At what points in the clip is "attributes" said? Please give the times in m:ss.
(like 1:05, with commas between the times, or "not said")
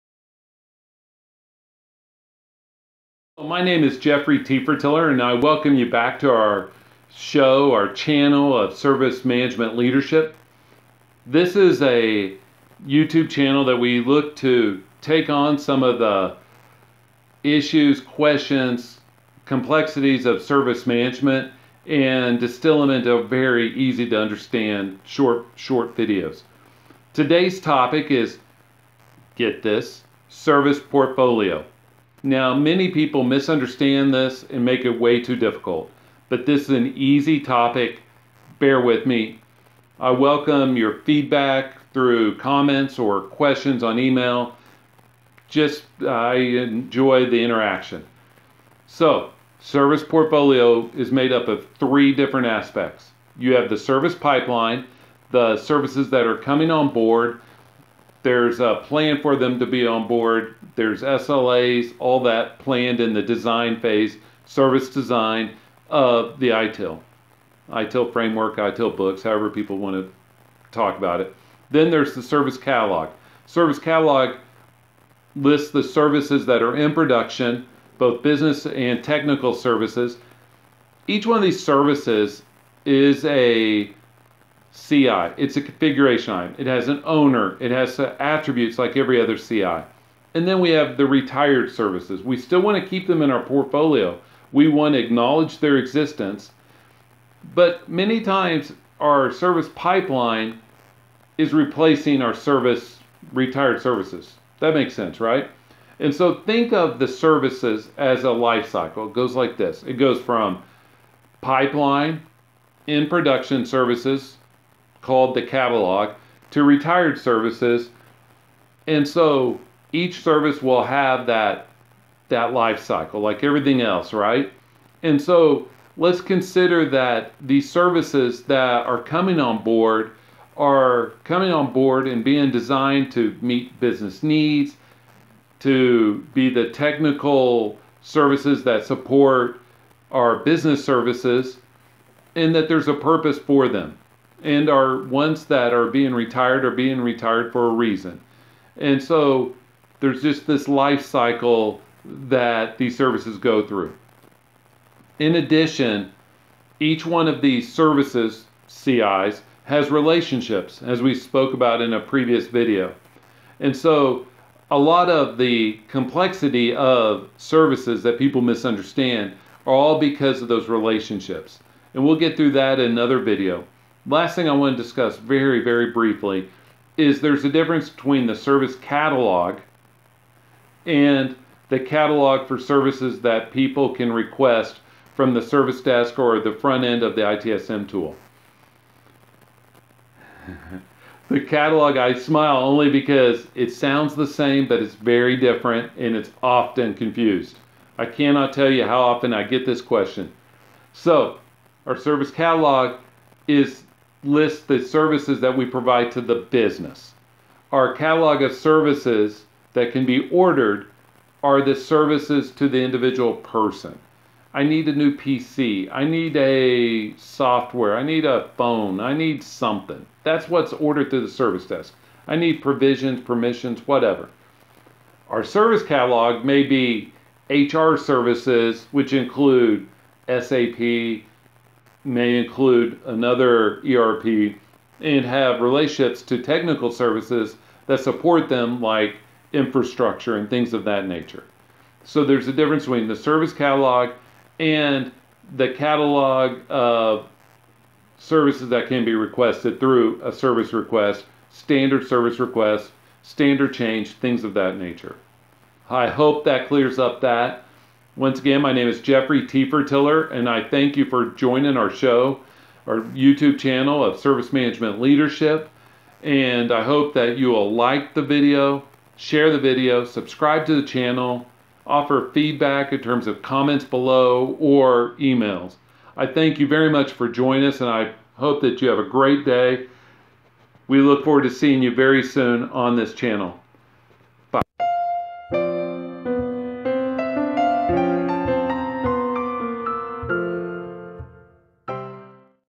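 1:27.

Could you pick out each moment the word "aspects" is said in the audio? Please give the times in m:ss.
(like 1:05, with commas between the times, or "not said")
0:52.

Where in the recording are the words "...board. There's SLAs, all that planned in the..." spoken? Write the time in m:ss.
1:00.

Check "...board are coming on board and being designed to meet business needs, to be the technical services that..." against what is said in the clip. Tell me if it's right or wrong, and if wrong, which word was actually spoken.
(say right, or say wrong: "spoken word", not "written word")
right.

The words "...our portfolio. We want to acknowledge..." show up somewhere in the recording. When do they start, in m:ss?
1:33.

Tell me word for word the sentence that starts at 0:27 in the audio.
Today's topic is get this service portfolio.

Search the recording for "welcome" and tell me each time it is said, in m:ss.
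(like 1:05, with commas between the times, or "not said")
0:05, 0:40.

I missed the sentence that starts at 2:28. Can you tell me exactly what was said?
And so there's just this life cycle that these services go through.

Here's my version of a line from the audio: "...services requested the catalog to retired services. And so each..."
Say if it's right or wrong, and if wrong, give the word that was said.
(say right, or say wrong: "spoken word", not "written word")
wrong: "called", not "requested".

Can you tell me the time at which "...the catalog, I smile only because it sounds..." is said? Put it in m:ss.
3:11.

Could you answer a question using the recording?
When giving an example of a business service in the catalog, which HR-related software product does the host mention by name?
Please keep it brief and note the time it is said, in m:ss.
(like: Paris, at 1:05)
SAP, at 3:50.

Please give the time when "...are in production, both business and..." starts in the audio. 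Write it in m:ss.
1:16.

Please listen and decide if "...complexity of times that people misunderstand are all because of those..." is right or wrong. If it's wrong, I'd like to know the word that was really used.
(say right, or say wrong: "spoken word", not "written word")
wrong: "services", not "times".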